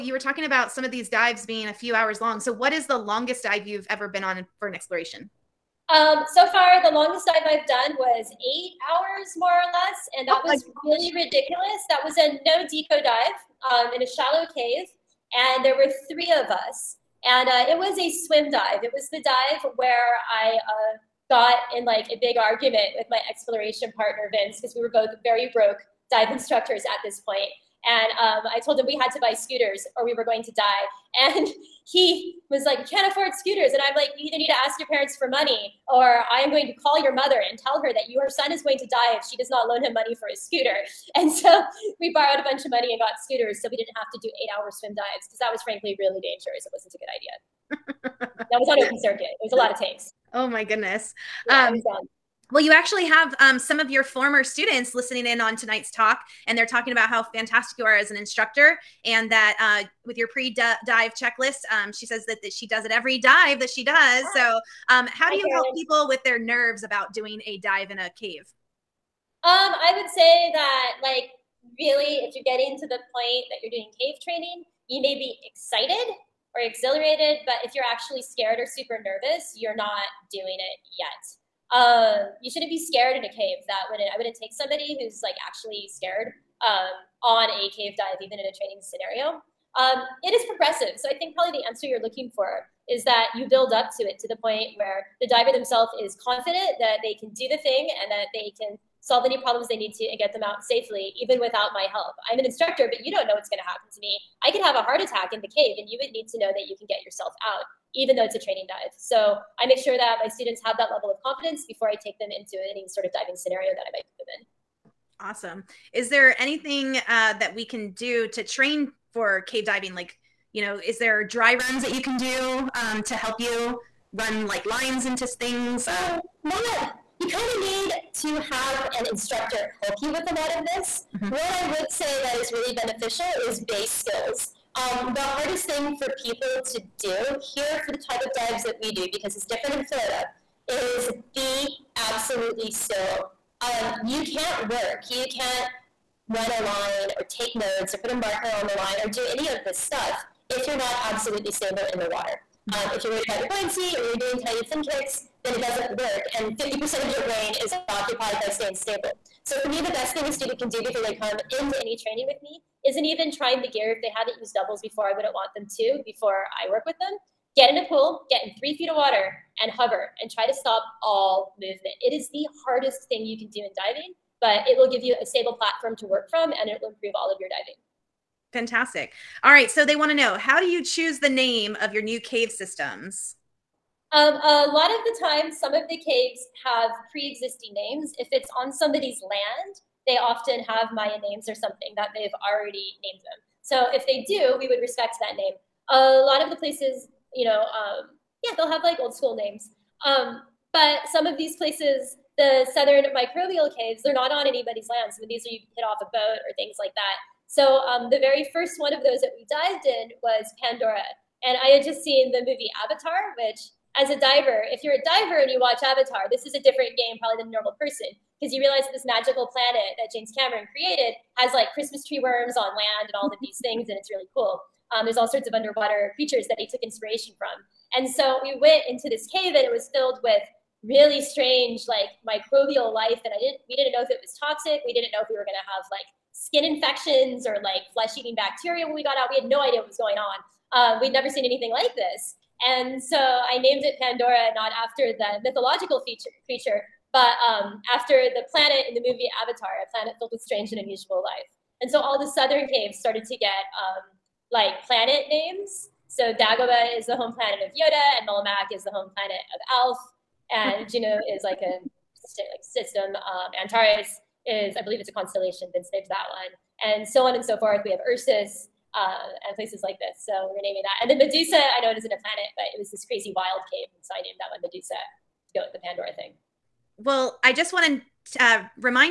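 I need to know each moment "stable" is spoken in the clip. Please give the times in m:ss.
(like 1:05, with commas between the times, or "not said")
2:31, 2:38, 2:55.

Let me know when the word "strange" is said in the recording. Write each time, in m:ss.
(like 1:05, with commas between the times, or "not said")
3:51, 4:10.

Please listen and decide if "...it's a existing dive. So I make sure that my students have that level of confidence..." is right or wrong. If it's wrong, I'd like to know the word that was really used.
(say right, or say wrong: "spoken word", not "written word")
wrong: "training", not "existing".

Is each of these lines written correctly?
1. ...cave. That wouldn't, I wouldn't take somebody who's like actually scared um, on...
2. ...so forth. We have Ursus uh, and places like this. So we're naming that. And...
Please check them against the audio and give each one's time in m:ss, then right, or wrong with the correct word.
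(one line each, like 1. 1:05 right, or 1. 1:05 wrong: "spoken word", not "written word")
1. 1:23 right
2. 4:27 right.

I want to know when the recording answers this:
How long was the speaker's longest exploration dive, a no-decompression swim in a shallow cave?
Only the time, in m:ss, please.
0:08.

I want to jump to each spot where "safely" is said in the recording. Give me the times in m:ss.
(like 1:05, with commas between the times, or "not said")
1:40.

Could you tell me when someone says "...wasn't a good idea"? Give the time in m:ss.
0:46.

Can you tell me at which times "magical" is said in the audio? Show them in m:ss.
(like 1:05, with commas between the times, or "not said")
3:39.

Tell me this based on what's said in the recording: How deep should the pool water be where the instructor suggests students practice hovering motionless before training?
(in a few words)
3 feet.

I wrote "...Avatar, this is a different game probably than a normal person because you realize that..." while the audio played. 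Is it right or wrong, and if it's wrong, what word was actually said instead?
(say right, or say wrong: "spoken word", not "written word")
right.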